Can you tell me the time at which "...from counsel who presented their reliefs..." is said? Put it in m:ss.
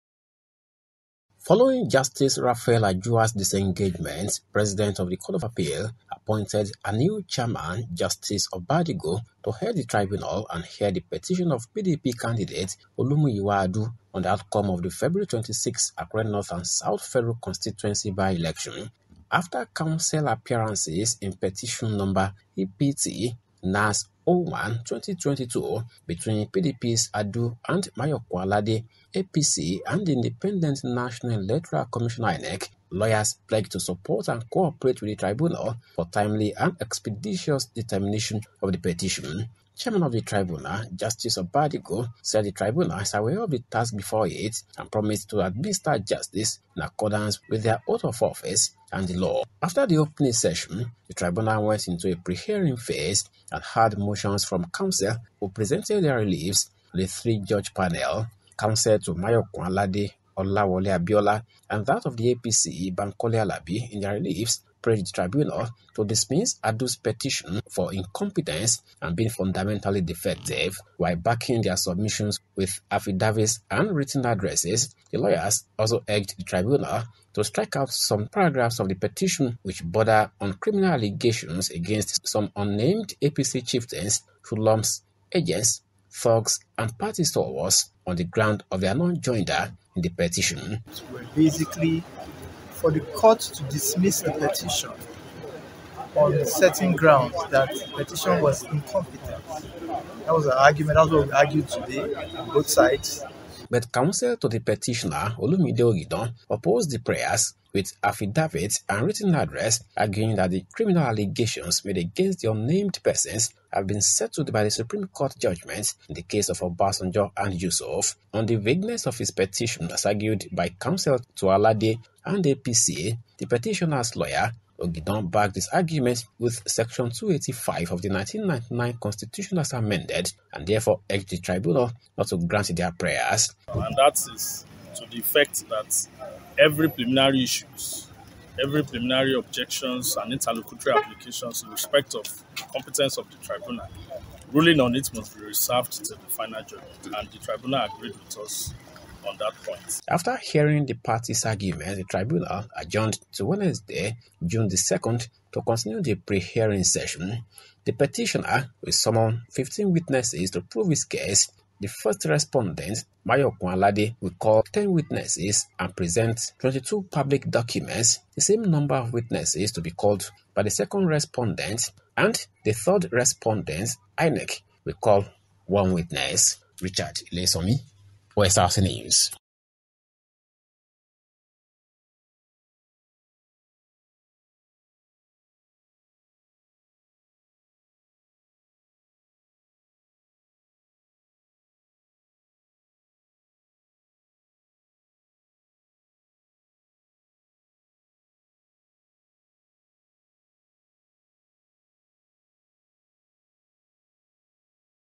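0:54.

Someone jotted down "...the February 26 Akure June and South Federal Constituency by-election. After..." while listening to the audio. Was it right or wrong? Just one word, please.
wrong.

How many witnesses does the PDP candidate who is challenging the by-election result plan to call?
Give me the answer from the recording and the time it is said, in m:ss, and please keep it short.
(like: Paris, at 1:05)
15, at 2:39.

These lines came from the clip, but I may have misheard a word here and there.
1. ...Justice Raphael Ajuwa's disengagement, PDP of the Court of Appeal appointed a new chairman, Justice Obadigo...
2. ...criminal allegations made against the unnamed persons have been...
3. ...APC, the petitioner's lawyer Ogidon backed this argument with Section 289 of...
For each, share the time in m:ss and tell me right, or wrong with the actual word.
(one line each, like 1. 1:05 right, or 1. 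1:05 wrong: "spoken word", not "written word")
1. 0:01 wrong: "President", not "PDP"
2. 1:50 right
3. 2:02 wrong: "285", not "289".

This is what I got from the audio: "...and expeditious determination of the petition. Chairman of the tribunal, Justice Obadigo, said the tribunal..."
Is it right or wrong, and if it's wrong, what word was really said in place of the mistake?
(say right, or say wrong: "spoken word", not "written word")
right.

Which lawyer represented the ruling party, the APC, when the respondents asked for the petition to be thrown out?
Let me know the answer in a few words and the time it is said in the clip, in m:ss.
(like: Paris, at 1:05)
Bankole Alabi, at 1:02.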